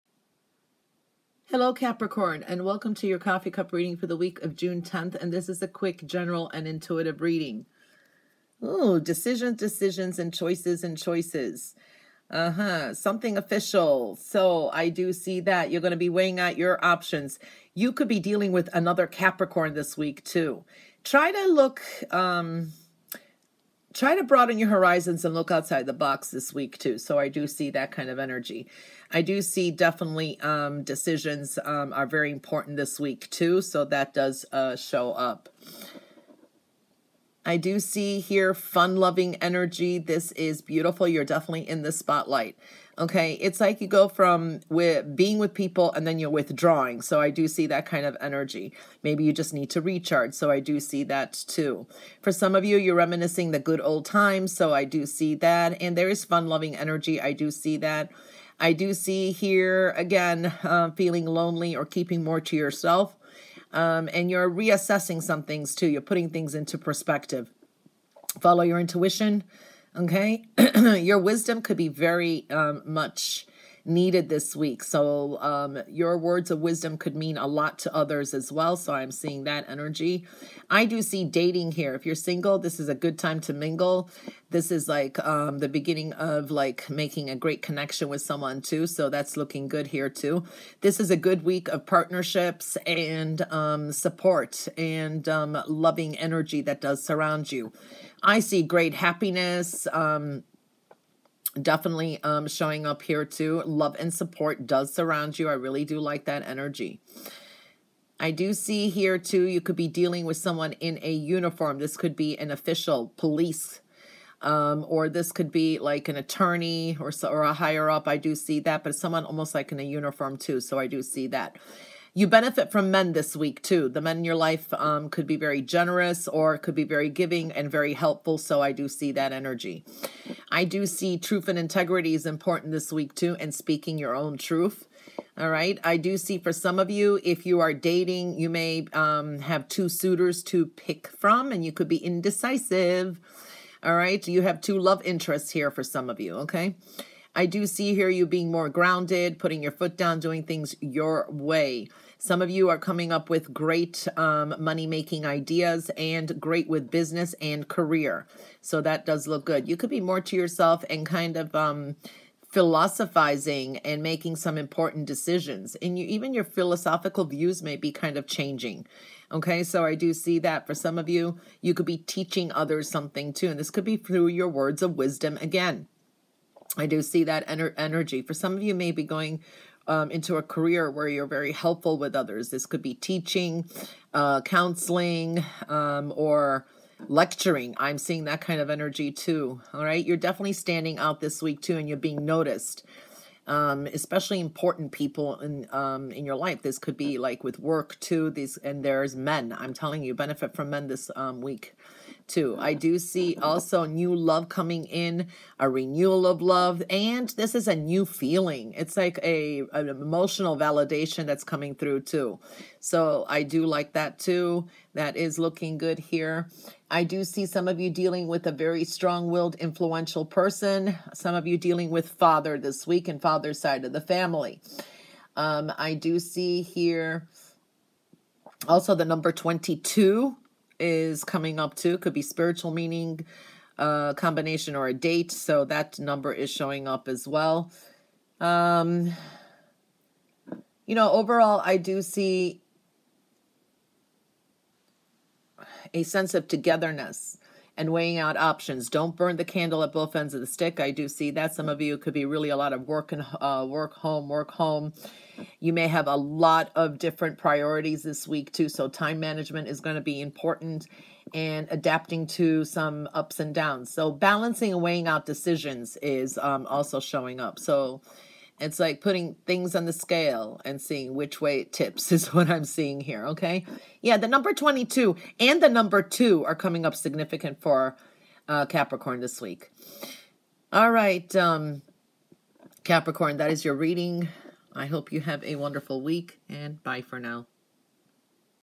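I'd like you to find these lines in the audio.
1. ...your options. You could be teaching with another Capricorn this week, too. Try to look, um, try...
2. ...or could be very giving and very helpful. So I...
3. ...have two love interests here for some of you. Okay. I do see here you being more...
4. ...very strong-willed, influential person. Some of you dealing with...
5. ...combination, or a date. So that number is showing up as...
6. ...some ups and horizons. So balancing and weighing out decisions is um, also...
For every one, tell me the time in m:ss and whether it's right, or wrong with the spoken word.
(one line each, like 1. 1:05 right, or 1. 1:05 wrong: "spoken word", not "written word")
1. 0:16 wrong: "dealing", not "teaching"
2. 2:06 right
3. 2:24 right
4. 3:38 right
5. 3:54 right
6. 4:22 wrong: "downs", not "horizons".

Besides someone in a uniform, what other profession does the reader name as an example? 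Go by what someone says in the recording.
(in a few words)
Attorney.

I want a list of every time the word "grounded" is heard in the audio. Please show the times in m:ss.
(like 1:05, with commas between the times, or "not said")
2:28.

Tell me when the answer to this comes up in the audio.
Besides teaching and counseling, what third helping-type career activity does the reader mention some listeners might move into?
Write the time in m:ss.
3:07.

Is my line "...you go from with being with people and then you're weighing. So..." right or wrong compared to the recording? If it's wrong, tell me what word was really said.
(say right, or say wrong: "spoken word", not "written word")
wrong: "withdrawing", not "weighing".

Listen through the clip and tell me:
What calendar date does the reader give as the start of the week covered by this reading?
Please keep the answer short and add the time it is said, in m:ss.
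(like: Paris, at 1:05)
June 10, at 0:04.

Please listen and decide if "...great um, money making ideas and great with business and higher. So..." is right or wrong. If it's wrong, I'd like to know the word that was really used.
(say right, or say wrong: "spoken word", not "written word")
wrong: "career", not "higher".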